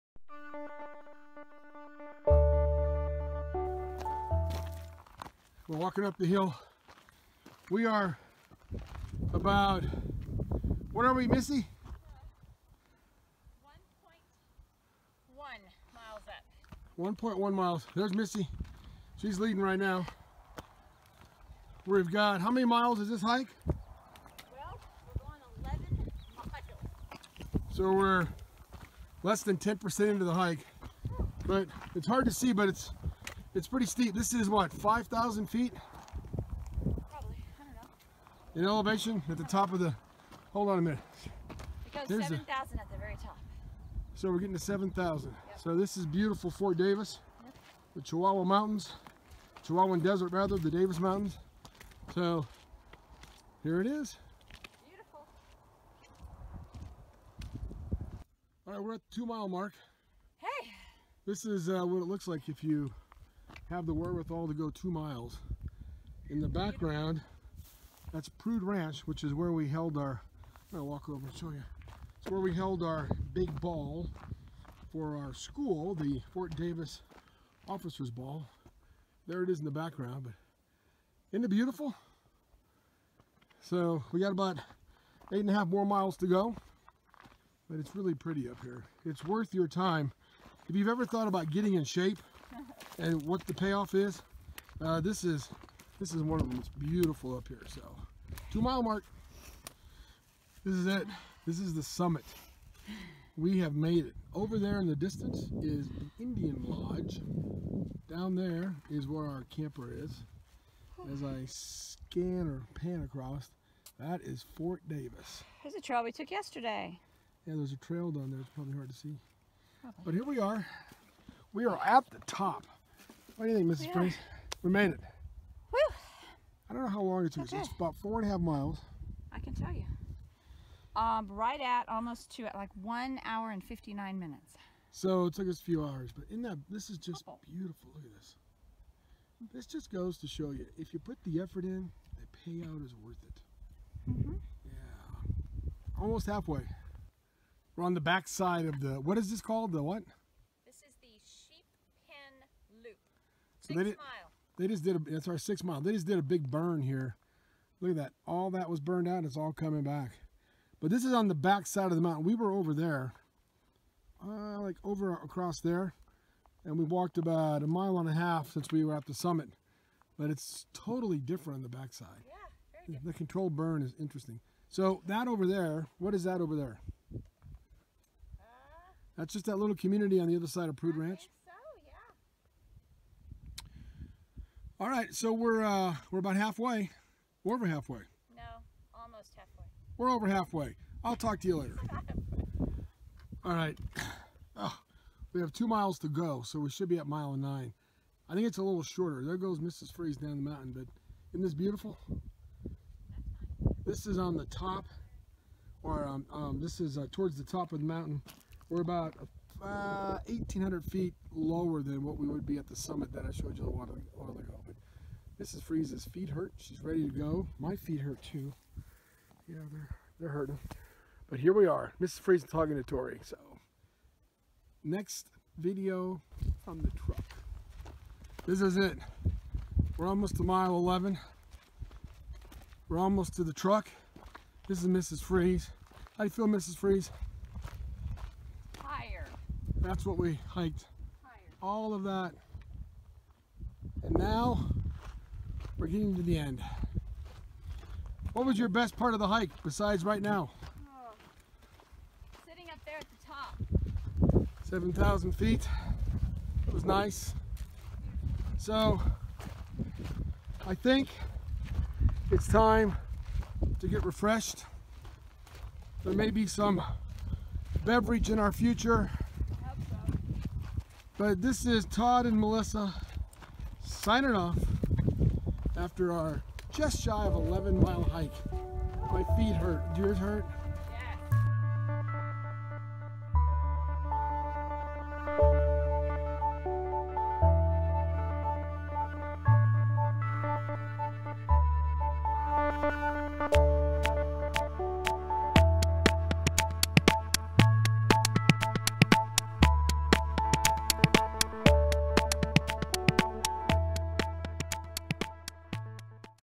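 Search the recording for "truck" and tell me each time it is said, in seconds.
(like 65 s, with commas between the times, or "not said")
226 s, 233 s.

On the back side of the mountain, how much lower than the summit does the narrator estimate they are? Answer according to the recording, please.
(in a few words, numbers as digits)
1,800 feet.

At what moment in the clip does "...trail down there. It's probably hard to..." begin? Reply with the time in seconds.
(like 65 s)
117 s.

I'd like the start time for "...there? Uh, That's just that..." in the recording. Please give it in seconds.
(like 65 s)
176 s.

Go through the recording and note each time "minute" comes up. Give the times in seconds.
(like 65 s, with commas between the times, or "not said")
40 s, 134 s.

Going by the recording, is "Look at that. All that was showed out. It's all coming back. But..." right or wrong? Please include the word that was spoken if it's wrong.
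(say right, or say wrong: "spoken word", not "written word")
wrong: "burned", not "showed".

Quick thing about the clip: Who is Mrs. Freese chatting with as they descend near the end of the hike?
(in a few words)
Tori.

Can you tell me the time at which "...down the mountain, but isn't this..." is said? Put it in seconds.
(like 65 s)
200 s.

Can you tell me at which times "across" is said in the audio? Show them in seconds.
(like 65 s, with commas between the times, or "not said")
113 s, 165 s.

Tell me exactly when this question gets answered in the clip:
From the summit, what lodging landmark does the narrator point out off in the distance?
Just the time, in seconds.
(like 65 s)
106 s.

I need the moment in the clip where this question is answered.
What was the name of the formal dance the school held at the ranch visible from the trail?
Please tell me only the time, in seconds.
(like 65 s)
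76 s.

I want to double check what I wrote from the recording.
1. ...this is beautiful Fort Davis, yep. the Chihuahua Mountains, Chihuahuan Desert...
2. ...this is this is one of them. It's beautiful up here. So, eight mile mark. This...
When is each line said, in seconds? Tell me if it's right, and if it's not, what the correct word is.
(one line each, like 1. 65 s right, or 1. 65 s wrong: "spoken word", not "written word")
1. 45 s right
2. 95 s wrong: "two", not "eight".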